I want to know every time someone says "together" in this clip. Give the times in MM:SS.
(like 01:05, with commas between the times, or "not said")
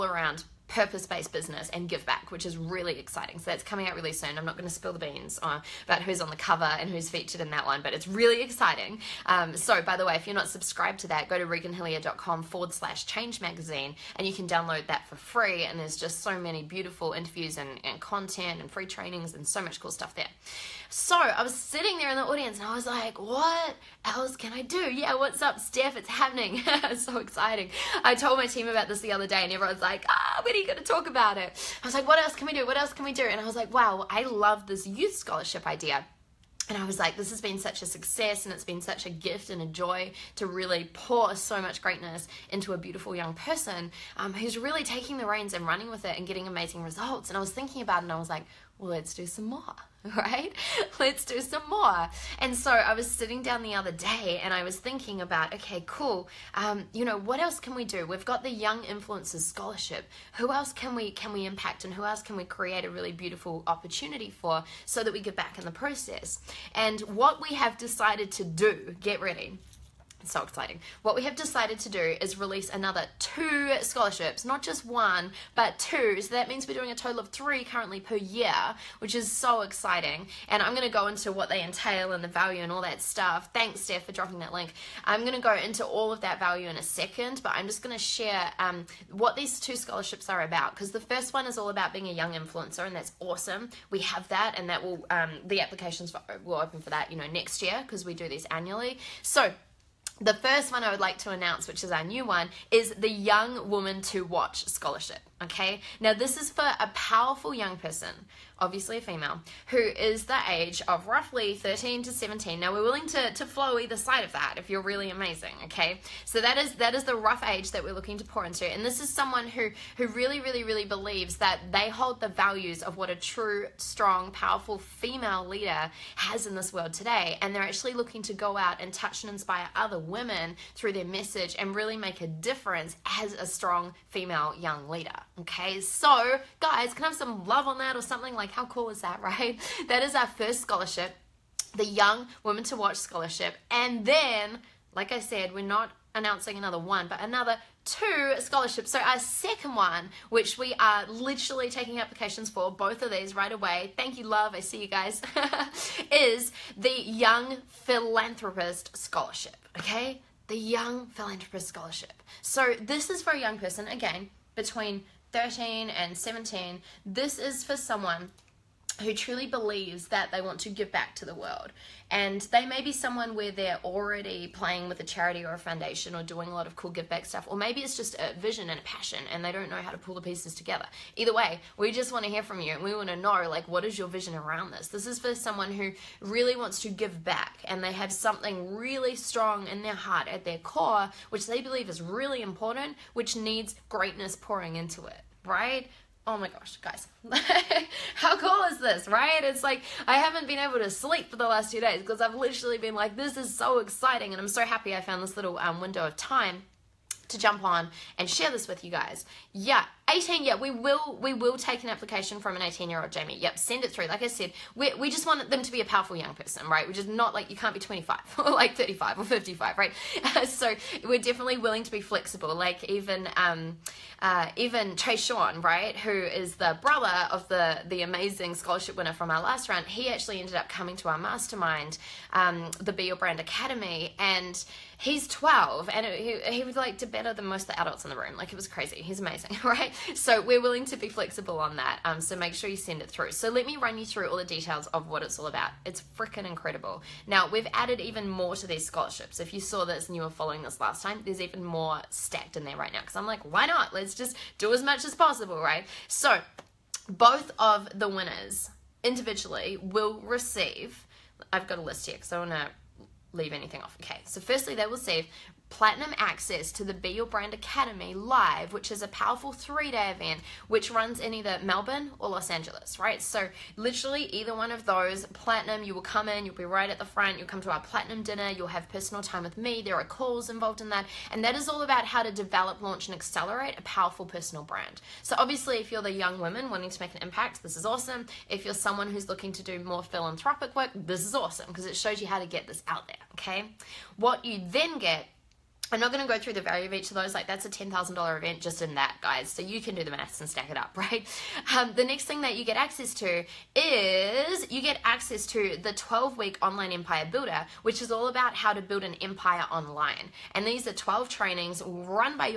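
03:00.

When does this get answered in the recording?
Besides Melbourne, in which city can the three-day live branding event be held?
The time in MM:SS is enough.
04:32.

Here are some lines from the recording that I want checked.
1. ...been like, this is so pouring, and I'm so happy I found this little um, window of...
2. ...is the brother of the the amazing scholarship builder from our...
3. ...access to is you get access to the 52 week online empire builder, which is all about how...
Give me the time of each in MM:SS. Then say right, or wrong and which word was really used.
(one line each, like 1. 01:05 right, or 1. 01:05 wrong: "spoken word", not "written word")
1. 03:22 wrong: "exciting", not "pouring"
2. 03:46 wrong: "winner", not "builder"
3. 05:02 wrong: "12", not "52".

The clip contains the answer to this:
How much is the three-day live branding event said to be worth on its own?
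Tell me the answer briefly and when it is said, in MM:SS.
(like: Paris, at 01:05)
$10,000, at 04:57.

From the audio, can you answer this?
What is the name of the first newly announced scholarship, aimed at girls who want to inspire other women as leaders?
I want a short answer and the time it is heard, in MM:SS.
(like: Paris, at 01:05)
Young Woman to Watch Scholarship, at 01:43.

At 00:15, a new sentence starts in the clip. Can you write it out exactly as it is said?
And there's just so many beautiful interviews and, and content and free trainings and so much cool stuff there.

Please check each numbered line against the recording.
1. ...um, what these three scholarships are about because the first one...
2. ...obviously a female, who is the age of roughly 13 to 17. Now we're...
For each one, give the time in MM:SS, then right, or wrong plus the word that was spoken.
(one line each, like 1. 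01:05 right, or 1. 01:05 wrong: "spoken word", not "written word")
1. 01:28 wrong: "two", not "three"
2. 01:48 right.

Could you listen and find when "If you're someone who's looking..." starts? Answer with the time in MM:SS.
04:48.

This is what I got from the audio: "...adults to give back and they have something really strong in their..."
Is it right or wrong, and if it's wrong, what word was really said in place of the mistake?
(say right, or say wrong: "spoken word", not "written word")
wrong: "wants", not "adults".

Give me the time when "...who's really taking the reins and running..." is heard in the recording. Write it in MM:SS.
00:44.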